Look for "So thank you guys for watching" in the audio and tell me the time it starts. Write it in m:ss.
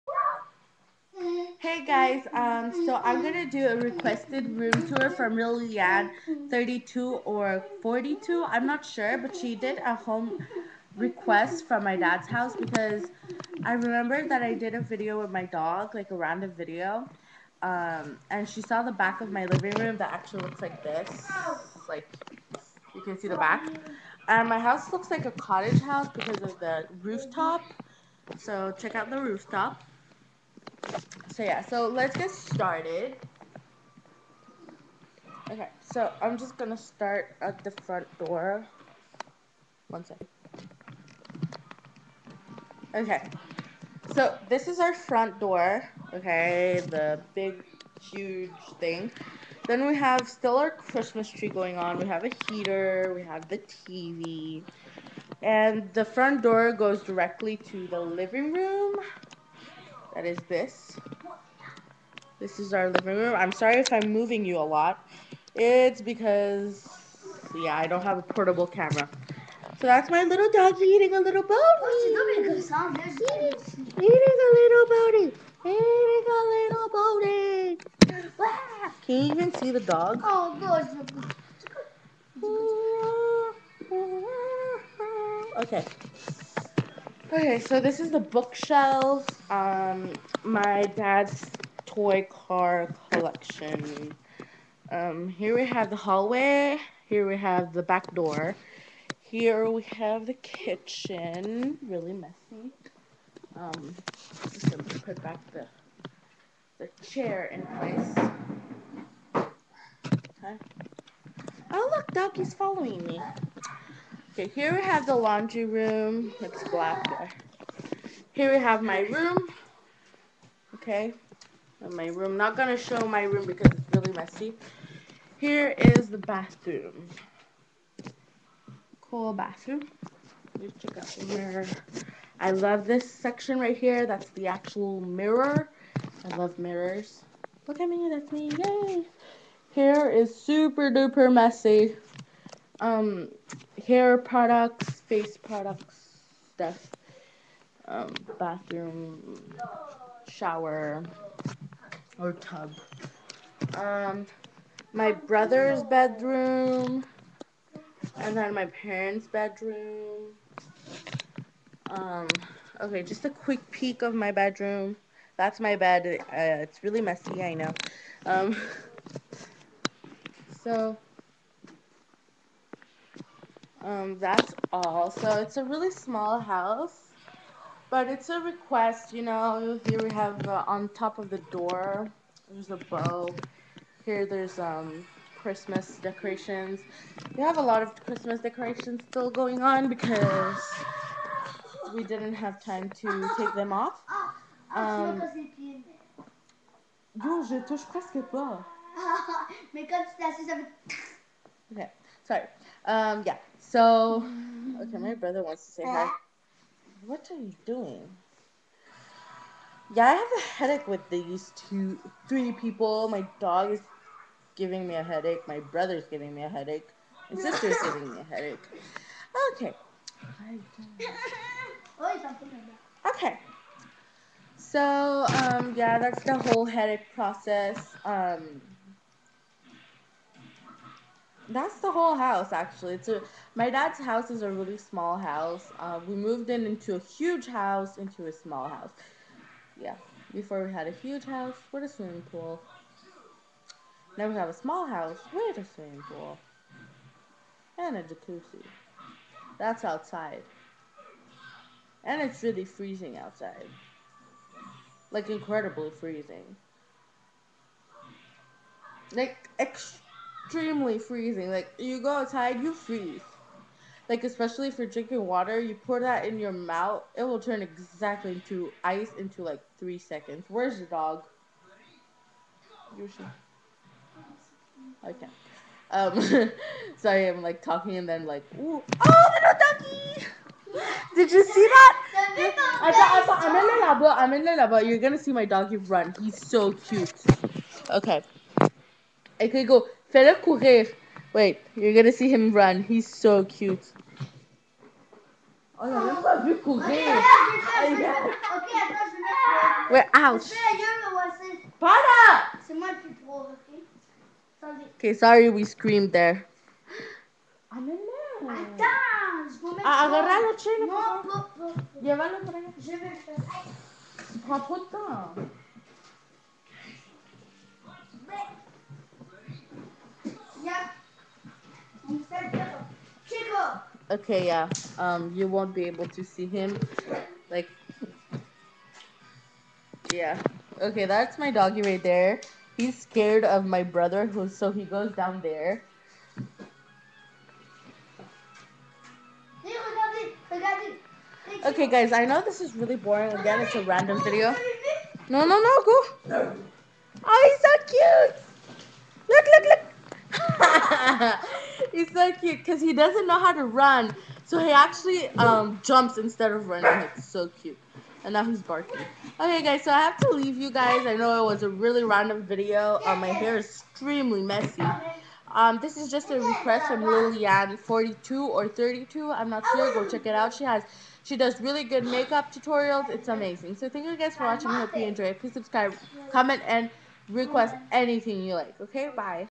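6:13.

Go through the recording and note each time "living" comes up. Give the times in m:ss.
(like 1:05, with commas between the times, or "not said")
0:19, 0:58, 1:02.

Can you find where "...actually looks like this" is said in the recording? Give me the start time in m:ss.
0:20.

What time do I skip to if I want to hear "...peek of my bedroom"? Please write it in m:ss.
2:43.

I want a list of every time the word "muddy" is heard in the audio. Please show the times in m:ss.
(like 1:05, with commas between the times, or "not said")
not said.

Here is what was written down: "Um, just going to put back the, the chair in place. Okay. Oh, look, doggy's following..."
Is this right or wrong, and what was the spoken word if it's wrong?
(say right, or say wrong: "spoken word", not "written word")
right.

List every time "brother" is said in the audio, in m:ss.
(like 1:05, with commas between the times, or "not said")
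2:35, 3:25, 3:35, 5:33.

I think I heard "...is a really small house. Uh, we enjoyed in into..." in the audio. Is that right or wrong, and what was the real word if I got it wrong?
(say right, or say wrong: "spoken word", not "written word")
wrong: "moved", not "enjoyed".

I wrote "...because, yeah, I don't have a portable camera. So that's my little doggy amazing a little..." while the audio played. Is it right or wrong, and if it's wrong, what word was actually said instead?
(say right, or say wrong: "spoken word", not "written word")
wrong: "eating", not "amazing".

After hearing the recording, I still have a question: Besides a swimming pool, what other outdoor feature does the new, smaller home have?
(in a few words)
Jacuzzi.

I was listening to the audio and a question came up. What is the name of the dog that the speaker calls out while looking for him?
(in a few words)
Yoshi.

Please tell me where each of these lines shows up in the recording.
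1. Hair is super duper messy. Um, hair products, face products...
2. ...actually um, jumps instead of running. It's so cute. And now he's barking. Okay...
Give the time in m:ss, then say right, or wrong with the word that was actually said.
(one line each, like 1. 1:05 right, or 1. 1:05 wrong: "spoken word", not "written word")
1. 2:19 right
2. 5:54 right.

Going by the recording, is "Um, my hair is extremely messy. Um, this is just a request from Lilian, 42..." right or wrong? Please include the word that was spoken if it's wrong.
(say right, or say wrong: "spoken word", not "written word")
right.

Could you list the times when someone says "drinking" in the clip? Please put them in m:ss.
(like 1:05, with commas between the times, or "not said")
4:24.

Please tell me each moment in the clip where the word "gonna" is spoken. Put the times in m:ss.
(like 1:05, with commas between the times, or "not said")
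0:03, 0:36, 2:02, 4:44, 4:51.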